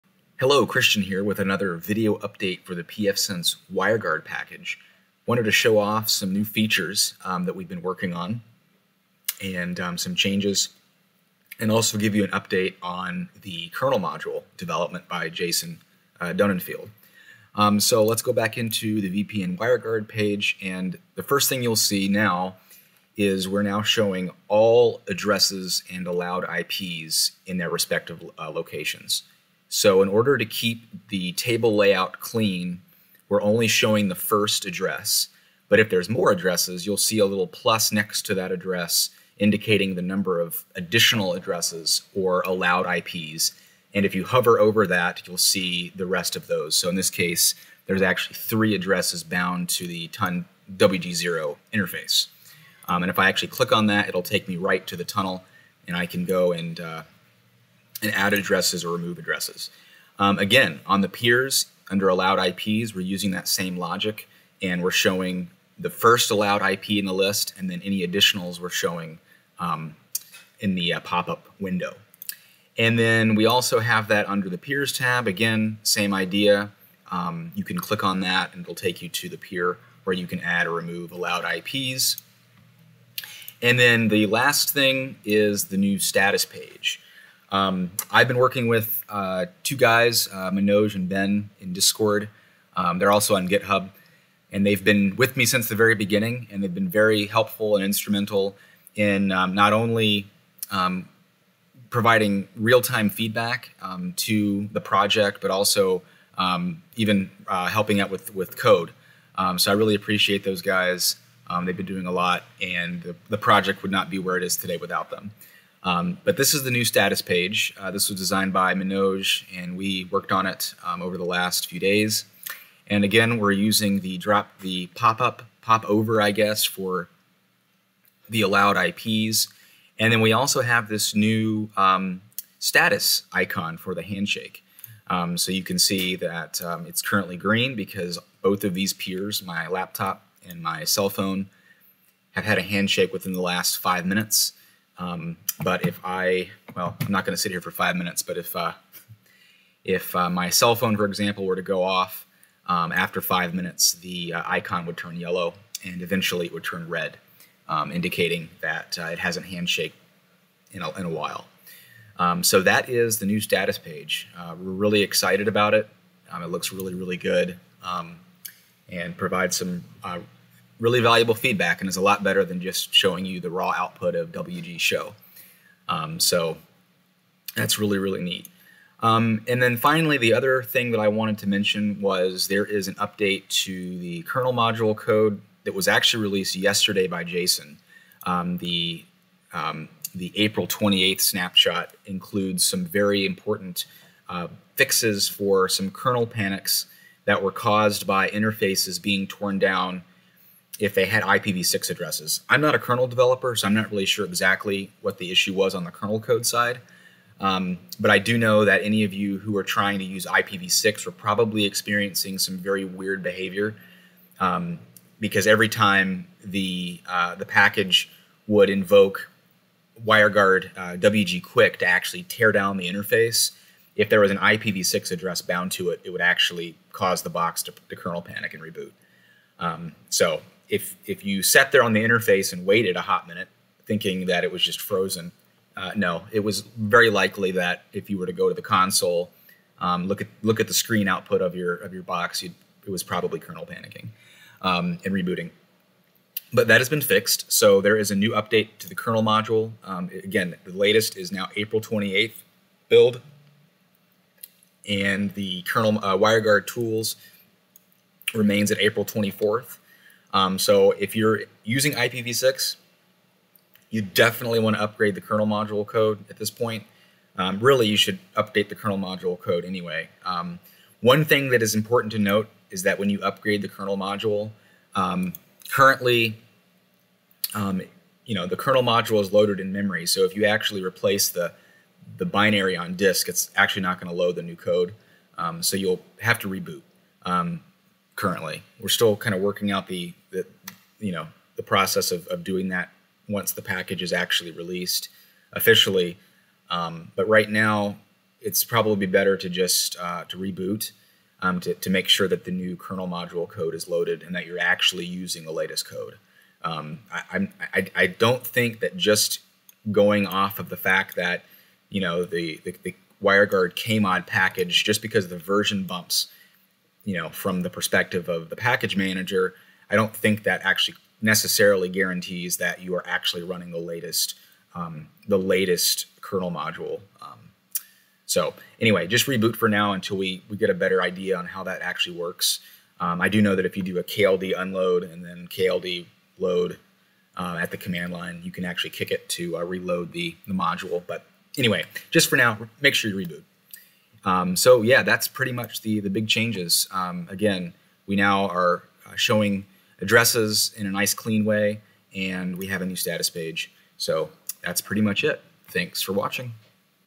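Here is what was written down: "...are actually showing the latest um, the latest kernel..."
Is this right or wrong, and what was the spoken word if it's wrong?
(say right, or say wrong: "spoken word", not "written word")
wrong: "running", not "showing".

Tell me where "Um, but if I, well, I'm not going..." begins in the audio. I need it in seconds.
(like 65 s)
145 s.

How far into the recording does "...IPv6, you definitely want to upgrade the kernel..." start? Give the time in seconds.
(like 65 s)
261 s.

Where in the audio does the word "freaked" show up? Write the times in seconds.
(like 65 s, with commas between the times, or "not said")
not said.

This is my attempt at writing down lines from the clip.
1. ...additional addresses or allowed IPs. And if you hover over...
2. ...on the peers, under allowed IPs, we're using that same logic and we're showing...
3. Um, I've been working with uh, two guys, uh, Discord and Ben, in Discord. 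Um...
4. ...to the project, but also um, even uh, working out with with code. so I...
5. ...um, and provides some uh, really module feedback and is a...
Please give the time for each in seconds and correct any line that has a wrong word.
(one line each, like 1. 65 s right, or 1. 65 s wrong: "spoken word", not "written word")
1. 40 s right
2. 60 s right
3. 87 s wrong: "Manoj", not "Discord"
4. 104 s wrong: "helping", not "working"
5. 167 s wrong: "valuable", not "module".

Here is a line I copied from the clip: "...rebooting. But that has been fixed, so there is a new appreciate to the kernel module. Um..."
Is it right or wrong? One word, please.
wrong.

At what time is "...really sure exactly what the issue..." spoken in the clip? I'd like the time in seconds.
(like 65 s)
203 s.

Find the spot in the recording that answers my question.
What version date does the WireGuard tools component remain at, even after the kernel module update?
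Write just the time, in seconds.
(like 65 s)
258 s.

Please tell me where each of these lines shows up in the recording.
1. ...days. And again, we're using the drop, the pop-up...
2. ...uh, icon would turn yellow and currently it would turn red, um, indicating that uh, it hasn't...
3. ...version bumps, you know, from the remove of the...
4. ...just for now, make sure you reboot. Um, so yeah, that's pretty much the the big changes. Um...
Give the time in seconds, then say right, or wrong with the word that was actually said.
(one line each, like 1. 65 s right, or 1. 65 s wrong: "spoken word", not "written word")
1. 121 s right
2. 154 s wrong: "eventually", not "currently"
3. 315 s wrong: "perspective", not "remove"
4. 342 s right.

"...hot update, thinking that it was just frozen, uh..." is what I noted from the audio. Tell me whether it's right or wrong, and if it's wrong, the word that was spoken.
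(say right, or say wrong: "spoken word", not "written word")
wrong: "minute", not "update".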